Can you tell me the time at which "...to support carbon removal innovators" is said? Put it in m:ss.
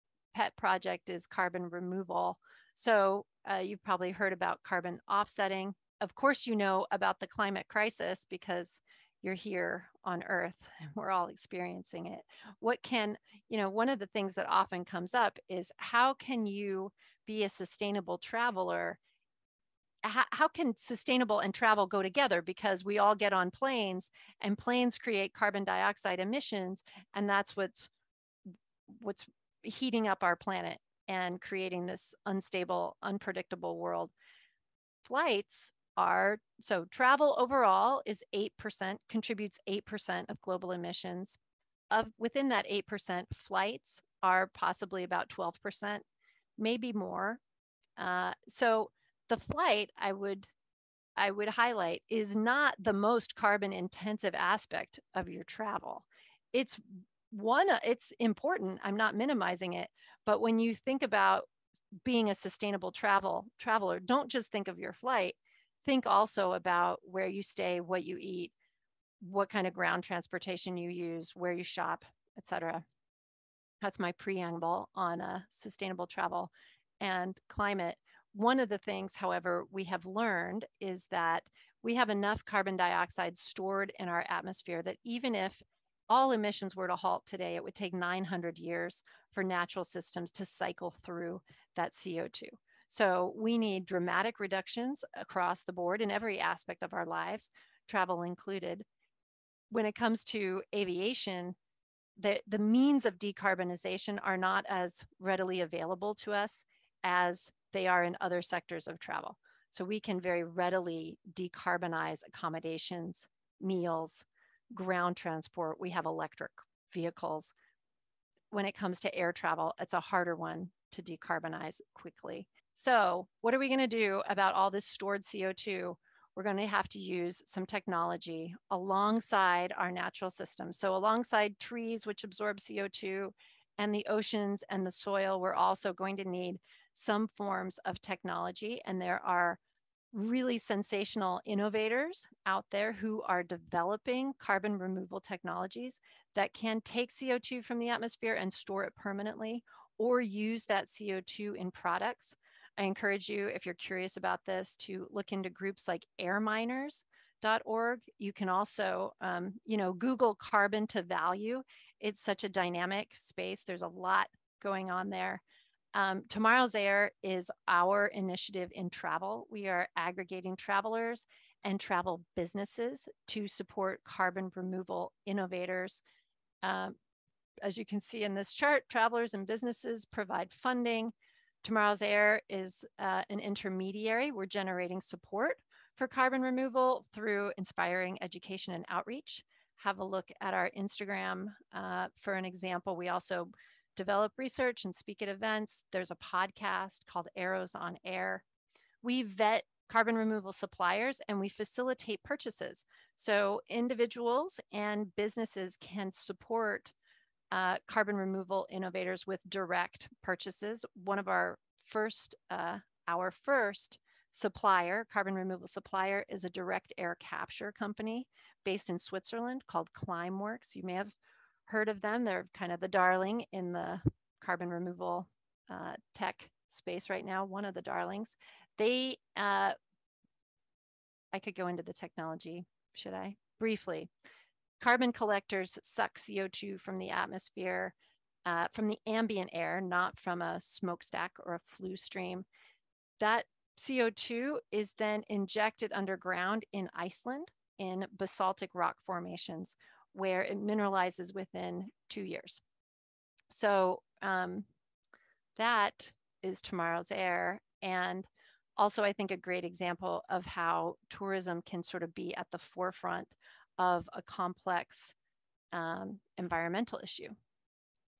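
2:53.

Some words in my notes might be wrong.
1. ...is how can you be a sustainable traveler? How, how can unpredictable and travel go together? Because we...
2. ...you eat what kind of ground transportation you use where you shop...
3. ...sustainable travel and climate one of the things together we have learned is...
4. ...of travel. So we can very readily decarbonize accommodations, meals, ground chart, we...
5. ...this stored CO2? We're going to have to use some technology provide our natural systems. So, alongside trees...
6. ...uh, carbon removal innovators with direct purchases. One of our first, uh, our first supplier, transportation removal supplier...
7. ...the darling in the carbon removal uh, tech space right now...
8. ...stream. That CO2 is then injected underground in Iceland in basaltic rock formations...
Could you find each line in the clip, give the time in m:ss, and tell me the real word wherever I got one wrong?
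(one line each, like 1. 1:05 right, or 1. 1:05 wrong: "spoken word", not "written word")
1. 0:15 wrong: "sustainable", not "unpredictable"
2. 1:08 right
3. 1:15 wrong: "however", not "together"
4. 1:48 wrong: "transport", not "chart"
5. 2:04 wrong: "alongside", not "provide"
6. 3:27 wrong: "carbon", not "transportation"
7. 3:42 right
8. 4:01 right.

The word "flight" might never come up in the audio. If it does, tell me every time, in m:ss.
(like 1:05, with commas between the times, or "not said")
0:35, 0:43, 0:49, 1:04.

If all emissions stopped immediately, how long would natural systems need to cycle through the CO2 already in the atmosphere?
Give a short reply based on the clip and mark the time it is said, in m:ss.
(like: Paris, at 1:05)
900 years, at 1:27.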